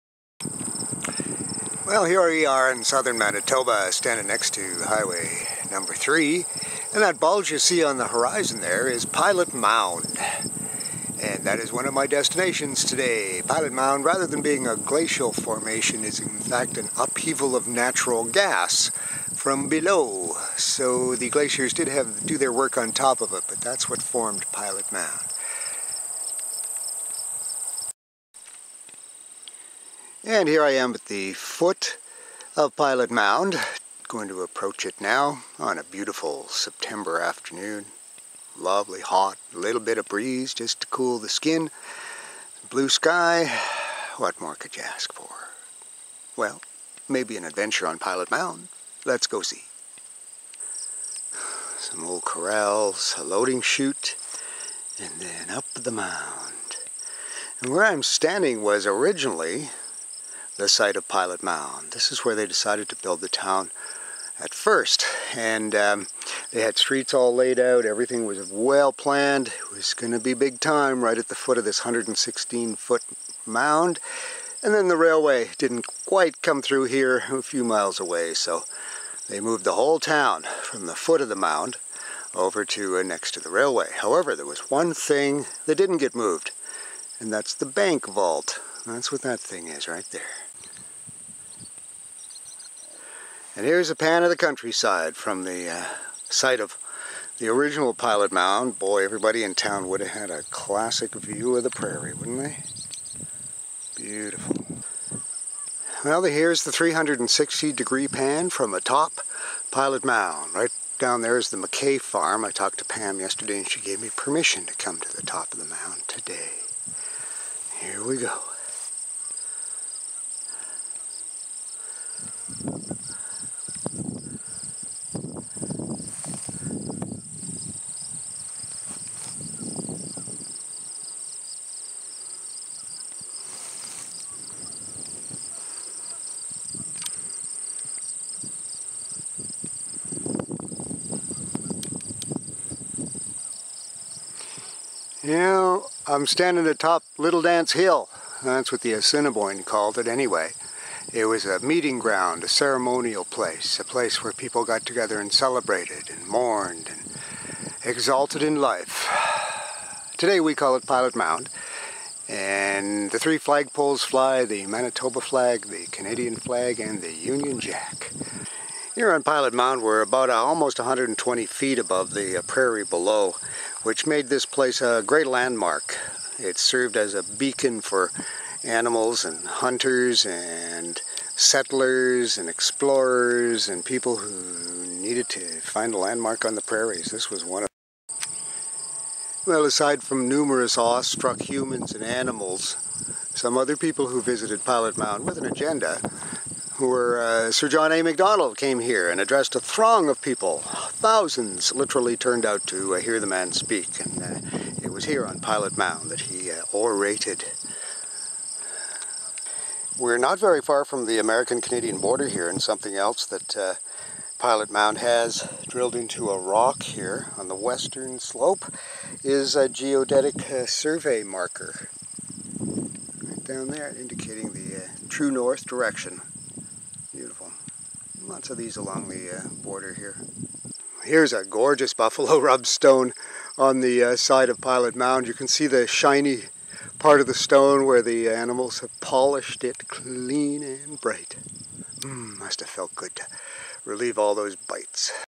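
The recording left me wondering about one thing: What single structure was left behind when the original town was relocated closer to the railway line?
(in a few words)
The bank vault.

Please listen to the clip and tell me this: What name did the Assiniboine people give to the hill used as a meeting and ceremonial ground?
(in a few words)
Little Dance Hill.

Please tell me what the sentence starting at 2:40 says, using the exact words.
Today we call it Pilot Mound.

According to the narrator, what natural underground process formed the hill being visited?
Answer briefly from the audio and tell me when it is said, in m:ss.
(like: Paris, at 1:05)
Upheaval of natural gas, at 0:16.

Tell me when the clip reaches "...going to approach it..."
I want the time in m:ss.
0:34.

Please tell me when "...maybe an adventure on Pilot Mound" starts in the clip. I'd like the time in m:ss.
0:47.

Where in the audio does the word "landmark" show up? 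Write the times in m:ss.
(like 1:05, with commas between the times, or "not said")
2:55, 3:05.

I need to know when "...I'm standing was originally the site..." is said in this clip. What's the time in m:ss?
0:57.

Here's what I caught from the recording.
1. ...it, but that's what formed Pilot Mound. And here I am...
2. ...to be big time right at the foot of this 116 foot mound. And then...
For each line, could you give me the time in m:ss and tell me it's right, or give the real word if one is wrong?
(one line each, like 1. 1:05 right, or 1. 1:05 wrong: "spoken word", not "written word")
1. 0:23 right
2. 1:10 right.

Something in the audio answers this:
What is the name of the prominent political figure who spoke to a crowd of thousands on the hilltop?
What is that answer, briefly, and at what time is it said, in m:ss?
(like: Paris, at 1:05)
Sir John A. Macdonald, at 3:17.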